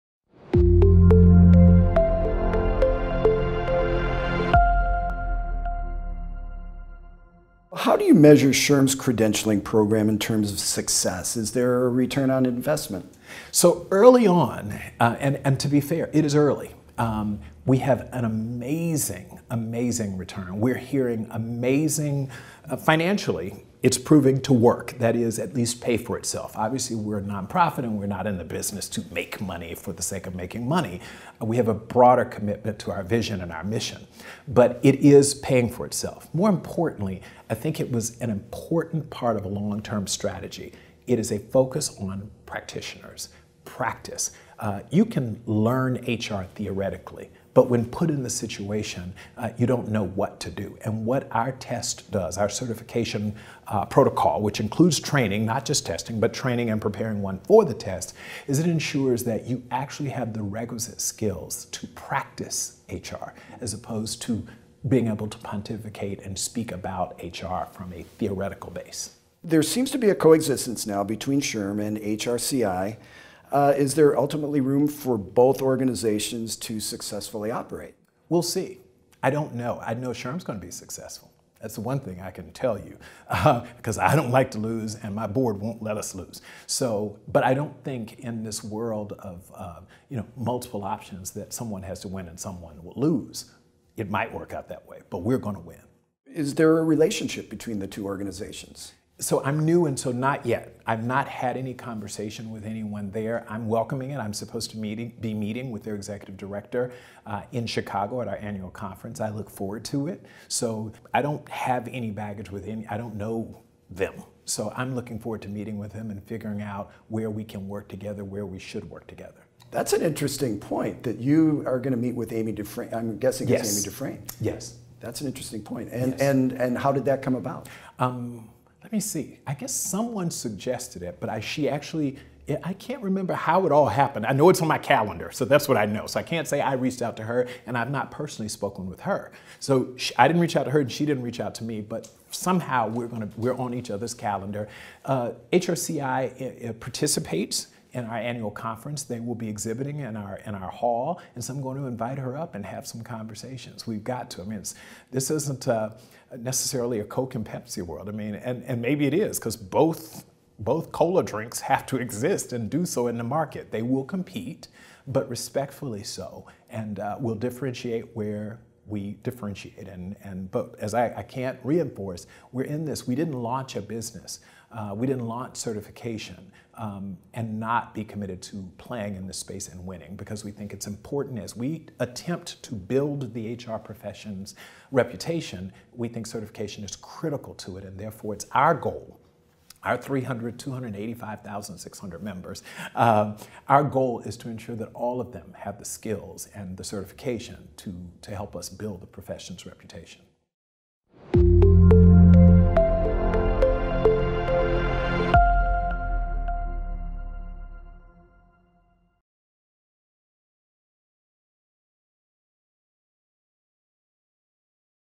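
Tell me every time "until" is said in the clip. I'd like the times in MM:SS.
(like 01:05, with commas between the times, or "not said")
not said.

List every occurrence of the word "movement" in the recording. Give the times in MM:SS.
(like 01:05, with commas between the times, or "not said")
not said.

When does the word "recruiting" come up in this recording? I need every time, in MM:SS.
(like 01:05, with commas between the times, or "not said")
not said.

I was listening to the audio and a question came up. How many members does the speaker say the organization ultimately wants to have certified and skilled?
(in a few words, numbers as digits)
285,600.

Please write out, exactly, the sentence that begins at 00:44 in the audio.
Uh, you can learn HR theoretically, but when put in the situation, uh, you don't know what to do.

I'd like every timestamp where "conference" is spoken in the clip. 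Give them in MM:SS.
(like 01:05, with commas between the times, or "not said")
01:48, 02:28.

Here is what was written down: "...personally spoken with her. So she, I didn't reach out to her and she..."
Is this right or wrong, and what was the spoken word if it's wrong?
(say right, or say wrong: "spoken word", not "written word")
right.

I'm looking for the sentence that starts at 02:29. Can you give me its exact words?
They will be exhibiting in our in our hall, and so I'm going to invite her up and have some conversations.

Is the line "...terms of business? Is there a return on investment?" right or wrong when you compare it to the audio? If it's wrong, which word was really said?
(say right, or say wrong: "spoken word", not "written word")
wrong: "success", not "business".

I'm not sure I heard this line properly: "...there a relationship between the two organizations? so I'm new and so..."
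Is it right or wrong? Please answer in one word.
right.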